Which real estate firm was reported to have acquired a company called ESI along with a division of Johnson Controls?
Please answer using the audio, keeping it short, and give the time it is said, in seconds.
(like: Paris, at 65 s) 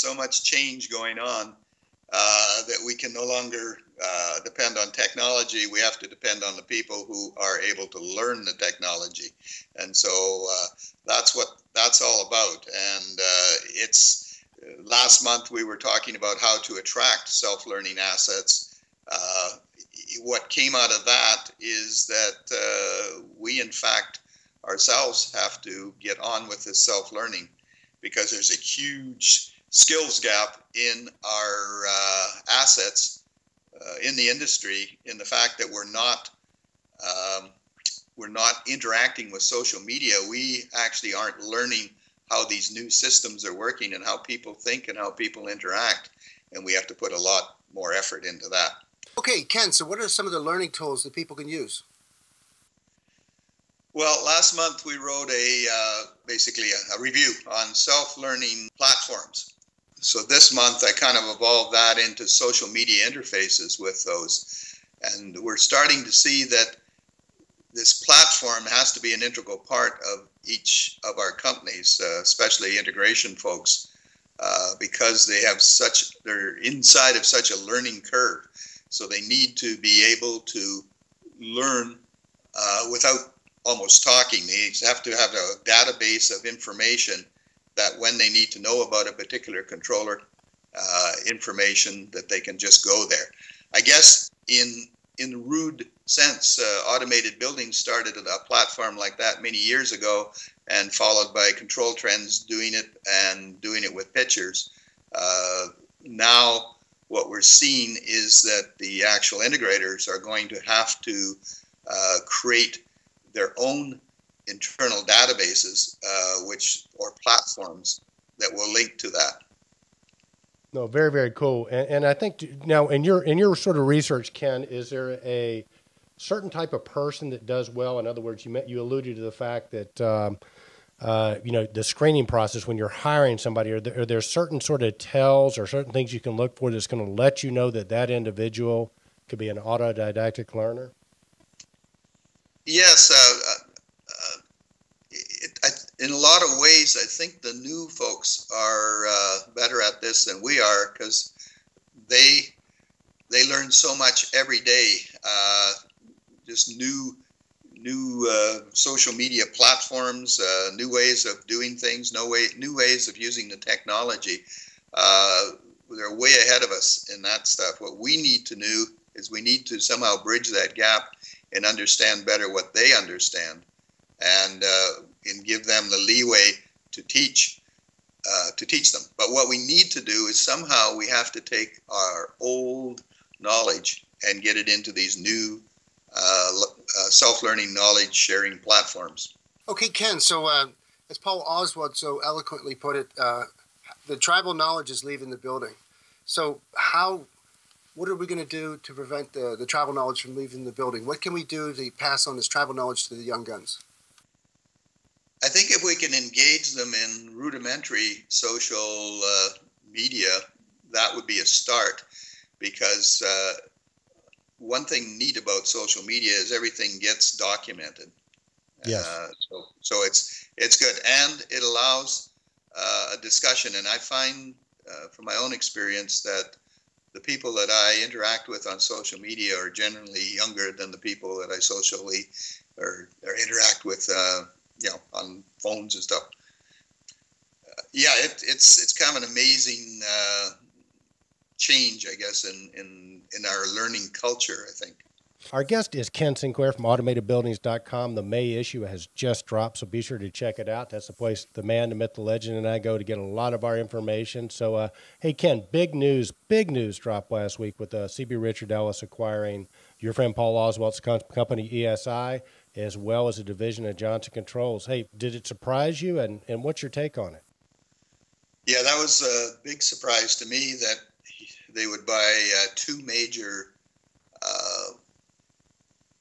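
CB Richard Ellis, at 258 s.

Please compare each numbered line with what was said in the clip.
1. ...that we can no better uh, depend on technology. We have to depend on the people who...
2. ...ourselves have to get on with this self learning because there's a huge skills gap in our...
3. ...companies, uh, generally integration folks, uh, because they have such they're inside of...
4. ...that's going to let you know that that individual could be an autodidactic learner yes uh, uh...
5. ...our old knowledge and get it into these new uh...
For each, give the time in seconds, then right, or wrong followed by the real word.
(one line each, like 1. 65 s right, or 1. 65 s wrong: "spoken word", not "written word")
1. 2 s wrong: "longer", not "better"
2. 24 s right
3. 71 s wrong: "especially", not "generally"
4. 136 s right
5. 181 s right.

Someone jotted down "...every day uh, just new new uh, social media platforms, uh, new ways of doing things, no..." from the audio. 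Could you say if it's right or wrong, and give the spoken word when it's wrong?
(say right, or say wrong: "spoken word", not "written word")
right.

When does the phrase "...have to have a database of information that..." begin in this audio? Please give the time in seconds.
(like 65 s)
84 s.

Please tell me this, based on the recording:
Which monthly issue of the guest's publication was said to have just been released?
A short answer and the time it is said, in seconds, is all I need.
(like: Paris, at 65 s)
May, at 248 s.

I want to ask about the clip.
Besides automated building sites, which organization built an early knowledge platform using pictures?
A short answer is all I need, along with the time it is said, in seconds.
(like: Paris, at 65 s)
Control Trends, at 101 s.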